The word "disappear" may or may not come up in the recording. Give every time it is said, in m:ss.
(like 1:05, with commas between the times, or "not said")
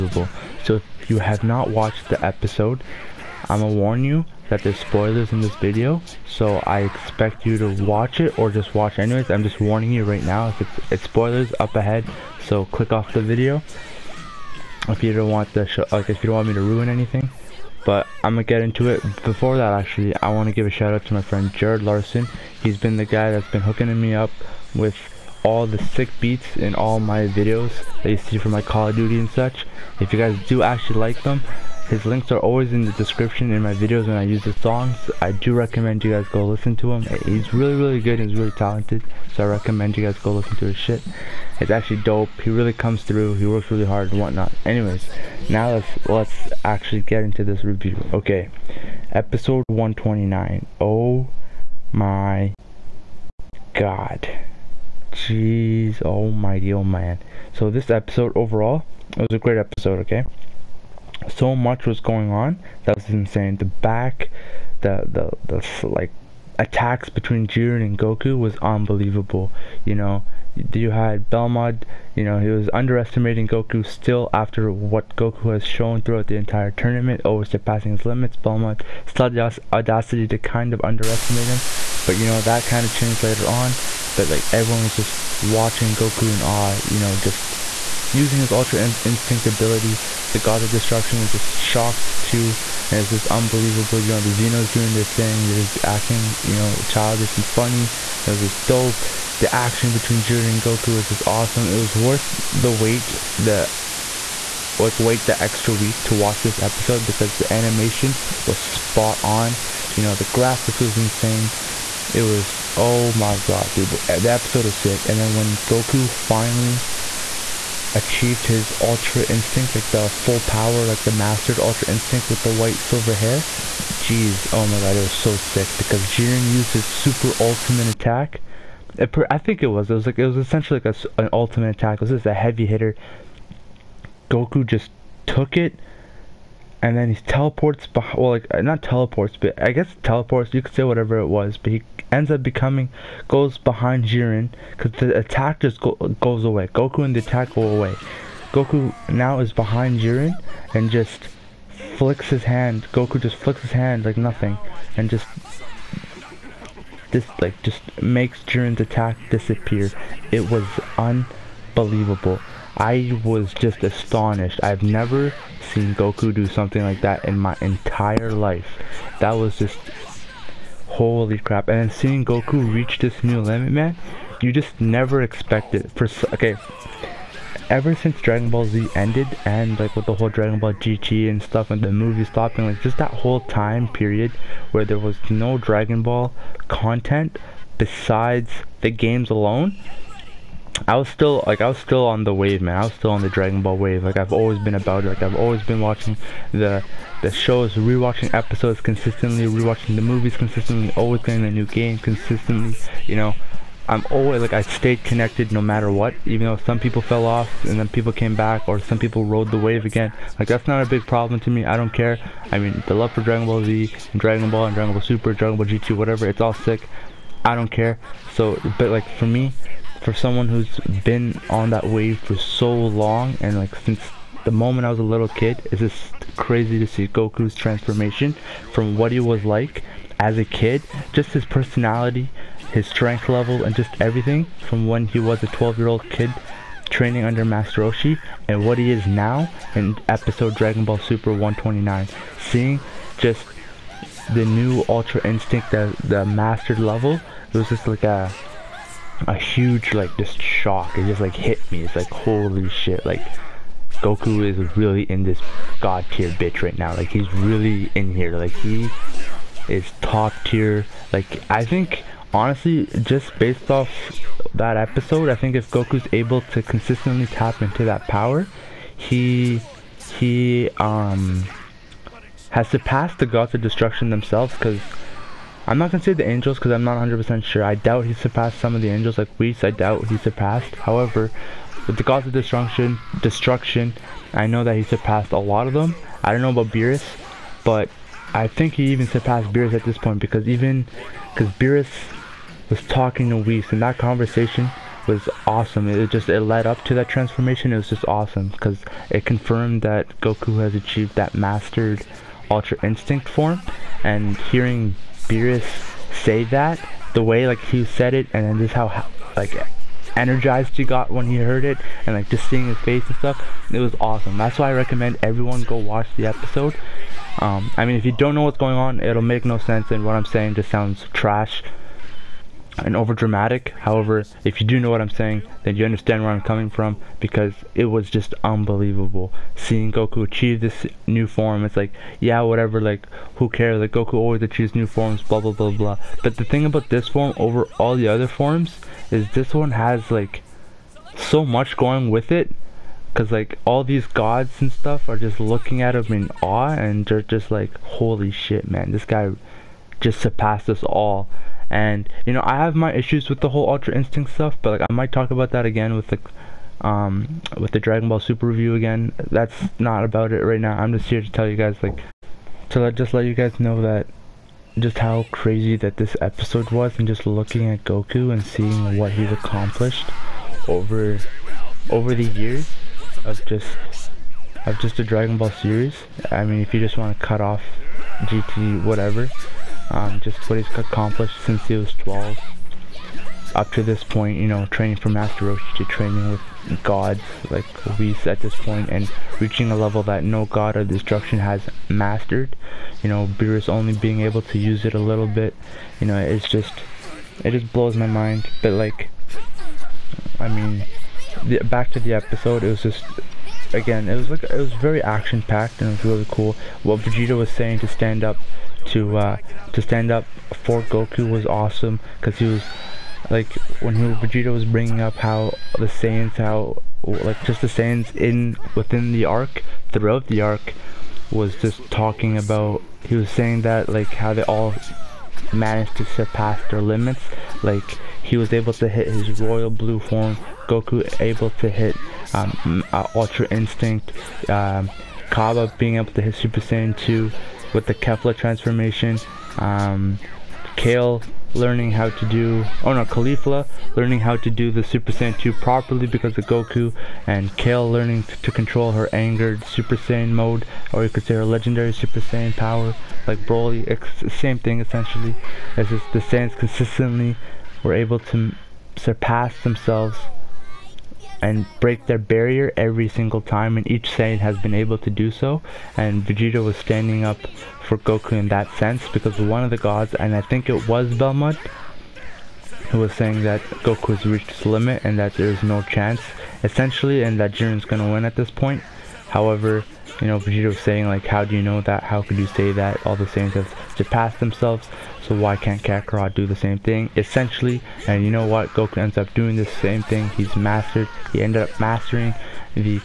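2:39.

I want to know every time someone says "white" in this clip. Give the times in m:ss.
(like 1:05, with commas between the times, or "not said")
2:02.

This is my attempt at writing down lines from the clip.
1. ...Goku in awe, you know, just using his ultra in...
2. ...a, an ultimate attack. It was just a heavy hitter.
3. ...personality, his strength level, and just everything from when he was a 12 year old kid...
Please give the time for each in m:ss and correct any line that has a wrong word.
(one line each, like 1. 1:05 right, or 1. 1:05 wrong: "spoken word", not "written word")
1. 1:25 right
2. 2:10 right
3. 3:51 right.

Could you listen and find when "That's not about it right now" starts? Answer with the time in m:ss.
5:59.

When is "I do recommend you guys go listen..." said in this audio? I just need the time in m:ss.
0:35.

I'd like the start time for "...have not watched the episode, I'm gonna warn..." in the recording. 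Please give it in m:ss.
0:01.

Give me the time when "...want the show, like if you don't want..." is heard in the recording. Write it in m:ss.
0:15.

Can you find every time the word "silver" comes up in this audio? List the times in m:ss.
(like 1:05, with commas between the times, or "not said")
2:02.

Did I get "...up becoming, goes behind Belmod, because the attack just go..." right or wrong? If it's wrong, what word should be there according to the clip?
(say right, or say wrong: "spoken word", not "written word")
wrong: "Jiren", not "Belmod".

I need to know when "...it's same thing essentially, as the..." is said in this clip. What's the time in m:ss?
7:33.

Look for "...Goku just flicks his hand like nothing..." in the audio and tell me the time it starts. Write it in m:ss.
2:32.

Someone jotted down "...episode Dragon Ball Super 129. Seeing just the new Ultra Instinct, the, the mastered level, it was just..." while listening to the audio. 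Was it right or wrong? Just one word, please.
right.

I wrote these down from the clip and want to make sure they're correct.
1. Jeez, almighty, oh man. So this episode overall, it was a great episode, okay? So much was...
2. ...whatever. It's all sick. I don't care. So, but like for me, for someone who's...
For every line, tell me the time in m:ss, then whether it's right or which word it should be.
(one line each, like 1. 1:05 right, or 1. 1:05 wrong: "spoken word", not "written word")
1. 0:55 right
2. 3:35 right.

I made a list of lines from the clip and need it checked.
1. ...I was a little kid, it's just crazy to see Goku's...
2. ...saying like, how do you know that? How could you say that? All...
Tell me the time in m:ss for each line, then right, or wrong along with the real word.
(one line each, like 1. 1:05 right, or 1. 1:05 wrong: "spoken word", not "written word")
1. 3:44 right
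2. 8:00 right.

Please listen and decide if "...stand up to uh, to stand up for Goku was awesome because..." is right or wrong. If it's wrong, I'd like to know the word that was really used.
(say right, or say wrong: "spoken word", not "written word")
right.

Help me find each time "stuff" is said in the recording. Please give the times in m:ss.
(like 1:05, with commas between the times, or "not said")
3:01, 5:13, 5:44, 5:54.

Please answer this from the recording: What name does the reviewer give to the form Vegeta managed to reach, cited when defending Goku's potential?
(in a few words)
royal blue form.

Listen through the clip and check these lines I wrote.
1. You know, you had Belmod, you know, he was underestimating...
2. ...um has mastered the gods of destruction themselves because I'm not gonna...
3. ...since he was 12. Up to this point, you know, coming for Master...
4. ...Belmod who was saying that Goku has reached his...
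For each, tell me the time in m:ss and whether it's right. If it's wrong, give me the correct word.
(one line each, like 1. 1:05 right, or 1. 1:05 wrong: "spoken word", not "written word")
1. 1:09 right
2. 4:30 wrong: "surpassed", not "mastered"
3. 6:21 wrong: "training", not "coming"
4. 7:51 right.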